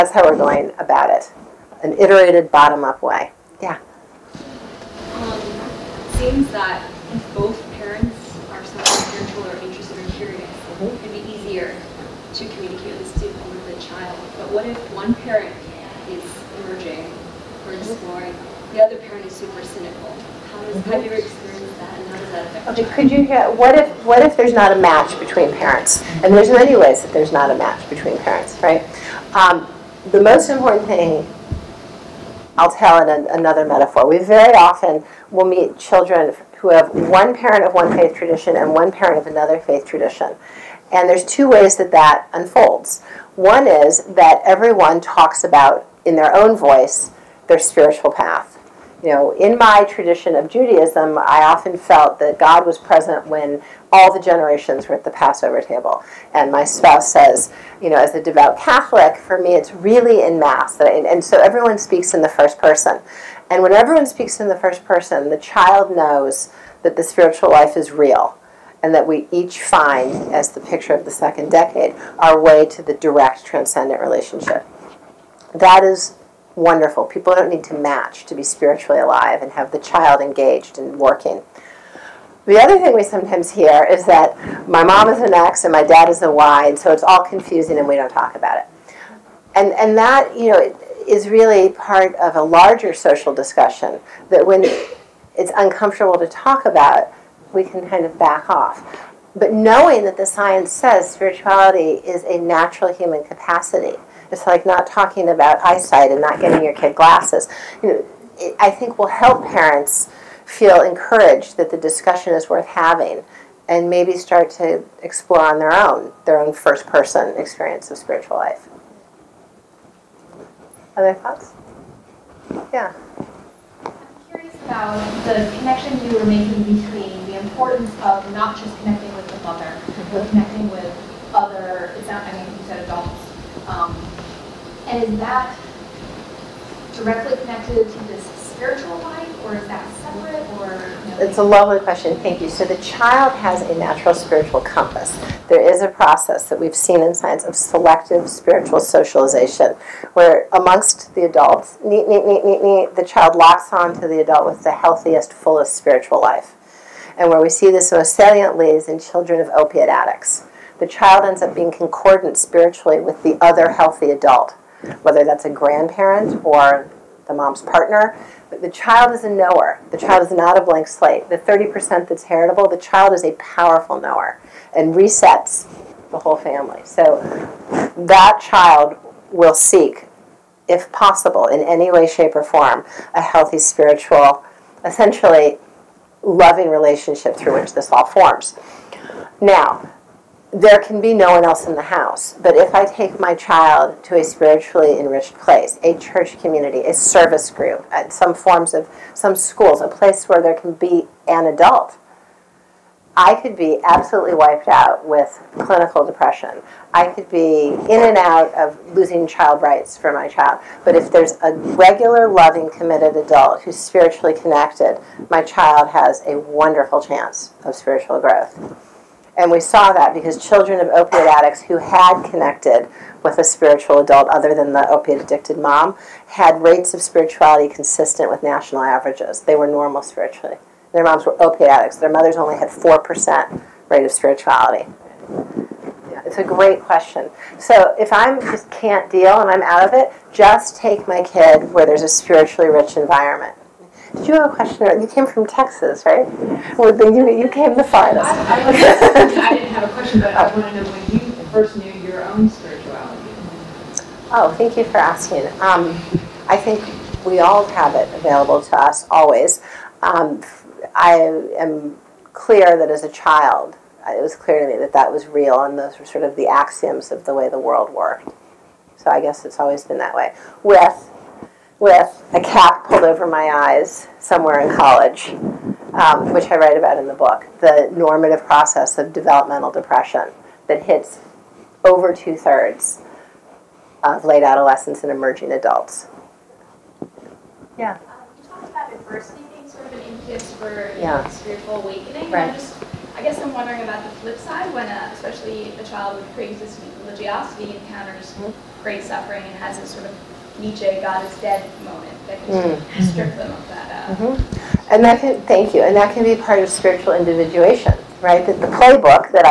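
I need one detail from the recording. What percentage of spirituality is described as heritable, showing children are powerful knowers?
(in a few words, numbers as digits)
30%.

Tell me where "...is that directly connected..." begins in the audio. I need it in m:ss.
2:15.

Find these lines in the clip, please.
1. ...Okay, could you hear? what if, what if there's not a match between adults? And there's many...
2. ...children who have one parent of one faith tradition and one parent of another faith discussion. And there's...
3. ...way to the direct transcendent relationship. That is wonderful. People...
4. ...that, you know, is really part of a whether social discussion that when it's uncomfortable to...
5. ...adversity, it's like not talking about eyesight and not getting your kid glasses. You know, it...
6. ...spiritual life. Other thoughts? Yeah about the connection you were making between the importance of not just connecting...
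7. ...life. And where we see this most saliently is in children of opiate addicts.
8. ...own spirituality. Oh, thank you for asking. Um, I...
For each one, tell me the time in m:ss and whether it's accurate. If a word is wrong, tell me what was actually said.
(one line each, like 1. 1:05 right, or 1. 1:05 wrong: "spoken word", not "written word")
1. 0:22 wrong: "parents", not "adults"
2. 0:35 wrong: "tradition", not "discussion"
3. 1:12 right
4. 1:29 wrong: "larger", not "whether"
5. 1:43 wrong: "capacity", not "adversity"
6. 1:57 right
7. 2:36 right
8. 4:12 right.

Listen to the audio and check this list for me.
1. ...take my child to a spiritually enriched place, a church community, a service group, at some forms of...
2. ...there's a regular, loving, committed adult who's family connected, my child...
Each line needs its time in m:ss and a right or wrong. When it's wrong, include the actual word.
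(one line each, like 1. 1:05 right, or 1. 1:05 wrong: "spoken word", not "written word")
1. 3:12 right
2. 3:31 wrong: "spiritually", not "family".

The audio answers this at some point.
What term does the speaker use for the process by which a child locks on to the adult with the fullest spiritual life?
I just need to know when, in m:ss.
2:27.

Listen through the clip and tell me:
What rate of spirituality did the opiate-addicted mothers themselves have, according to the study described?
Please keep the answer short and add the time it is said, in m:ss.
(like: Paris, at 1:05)
4%, at 3:52.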